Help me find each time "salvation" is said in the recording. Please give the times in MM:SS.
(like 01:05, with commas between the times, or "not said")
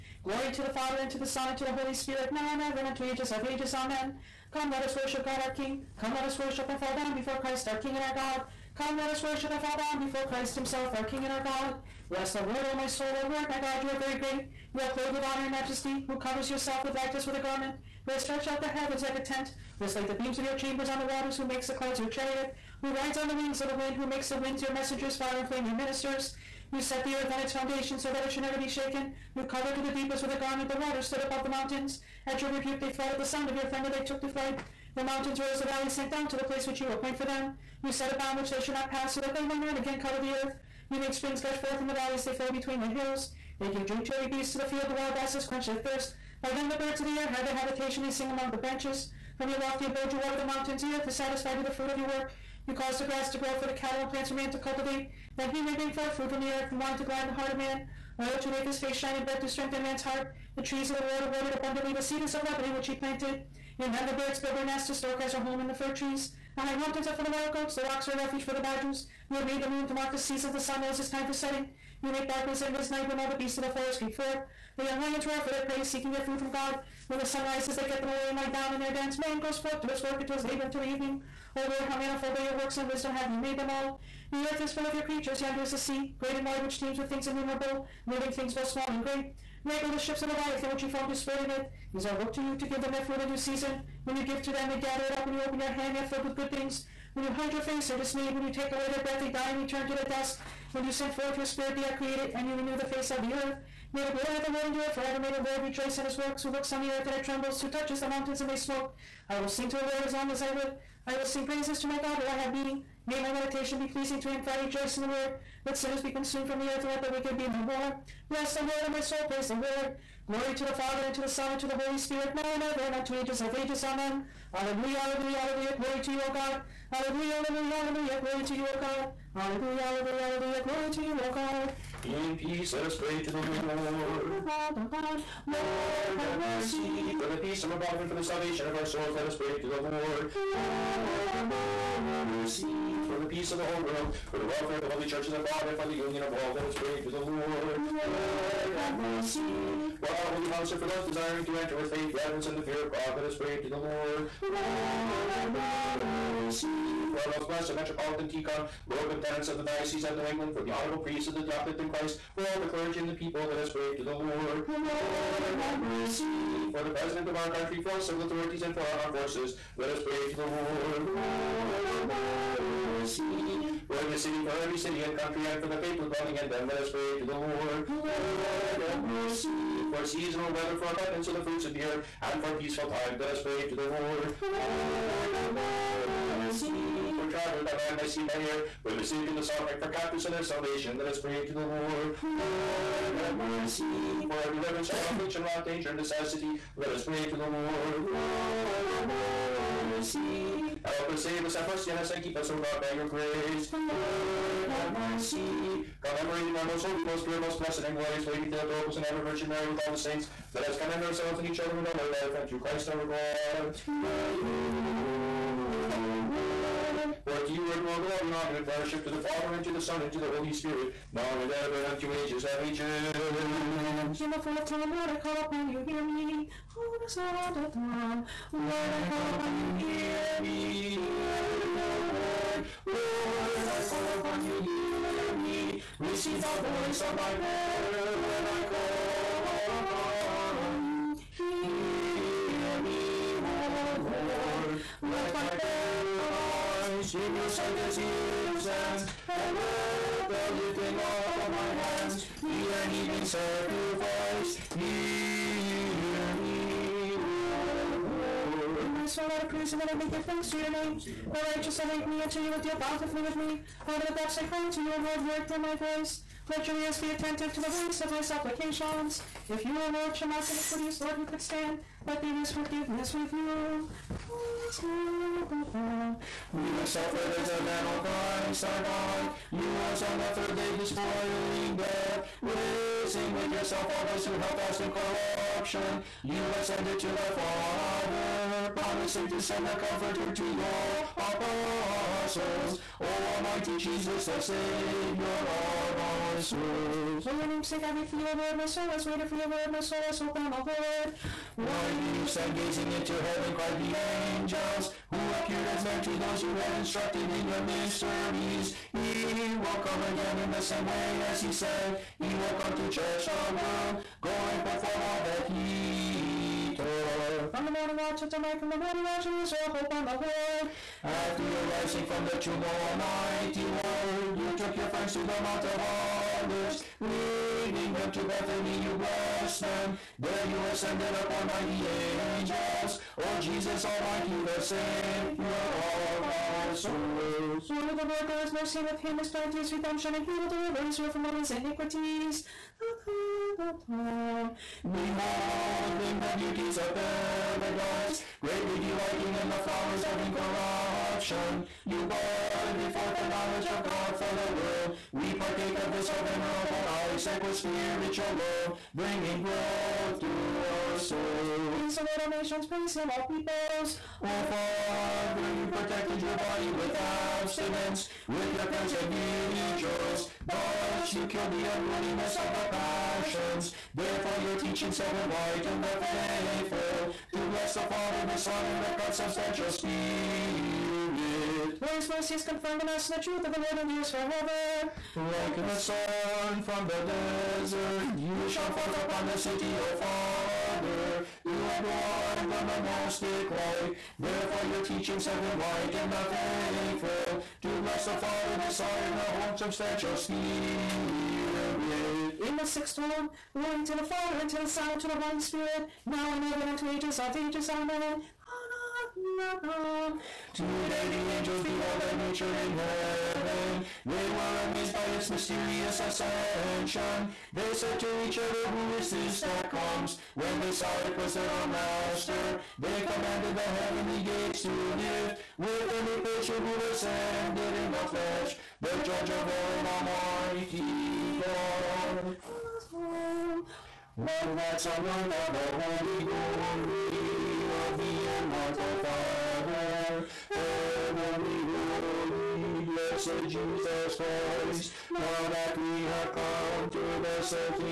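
02:18, 03:10.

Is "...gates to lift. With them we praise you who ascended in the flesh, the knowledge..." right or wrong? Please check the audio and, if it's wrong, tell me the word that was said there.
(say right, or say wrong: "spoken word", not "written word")
wrong: "judge", not "knowledge".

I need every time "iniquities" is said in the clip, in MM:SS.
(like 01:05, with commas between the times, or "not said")
04:30, 05:41.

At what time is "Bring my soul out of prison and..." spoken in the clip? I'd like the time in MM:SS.
04:18.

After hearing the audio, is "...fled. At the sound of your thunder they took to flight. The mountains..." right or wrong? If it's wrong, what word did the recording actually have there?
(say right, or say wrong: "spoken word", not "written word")
right.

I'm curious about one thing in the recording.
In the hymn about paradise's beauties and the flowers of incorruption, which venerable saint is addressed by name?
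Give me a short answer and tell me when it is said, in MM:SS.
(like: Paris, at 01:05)
Isaac, at 05:56.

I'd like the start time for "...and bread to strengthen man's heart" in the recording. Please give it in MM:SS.
00:59.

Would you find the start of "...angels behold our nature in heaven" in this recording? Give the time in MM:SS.
06:51.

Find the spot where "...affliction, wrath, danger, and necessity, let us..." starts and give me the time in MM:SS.
03:15.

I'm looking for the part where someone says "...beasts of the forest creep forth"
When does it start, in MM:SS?
01:13.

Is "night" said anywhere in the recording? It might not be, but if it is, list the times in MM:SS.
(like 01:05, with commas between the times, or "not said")
01:12, 05:18.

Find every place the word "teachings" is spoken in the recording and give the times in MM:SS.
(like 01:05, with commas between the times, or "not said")
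06:14, 06:34.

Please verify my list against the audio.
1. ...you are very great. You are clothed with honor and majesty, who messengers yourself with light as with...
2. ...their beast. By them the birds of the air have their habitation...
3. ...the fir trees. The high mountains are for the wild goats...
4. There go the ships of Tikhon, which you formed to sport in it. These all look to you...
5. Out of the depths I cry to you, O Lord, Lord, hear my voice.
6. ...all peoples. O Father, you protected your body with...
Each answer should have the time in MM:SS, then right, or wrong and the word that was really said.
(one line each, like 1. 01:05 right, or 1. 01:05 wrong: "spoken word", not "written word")
1. 00:13 wrong: "covers", not "messengers"
2. 00:45 wrong: "thirst", not "beast"
3. 01:05 right
4. 01:29 wrong: "Leviathan", not "Tikhon"
5. 04:23 right
6. 06:03 right.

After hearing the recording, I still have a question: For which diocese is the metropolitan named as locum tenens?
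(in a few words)
New England.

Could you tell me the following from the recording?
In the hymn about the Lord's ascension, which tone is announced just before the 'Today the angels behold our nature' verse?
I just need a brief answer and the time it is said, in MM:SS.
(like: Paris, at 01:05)
sixth tone, at 06:42.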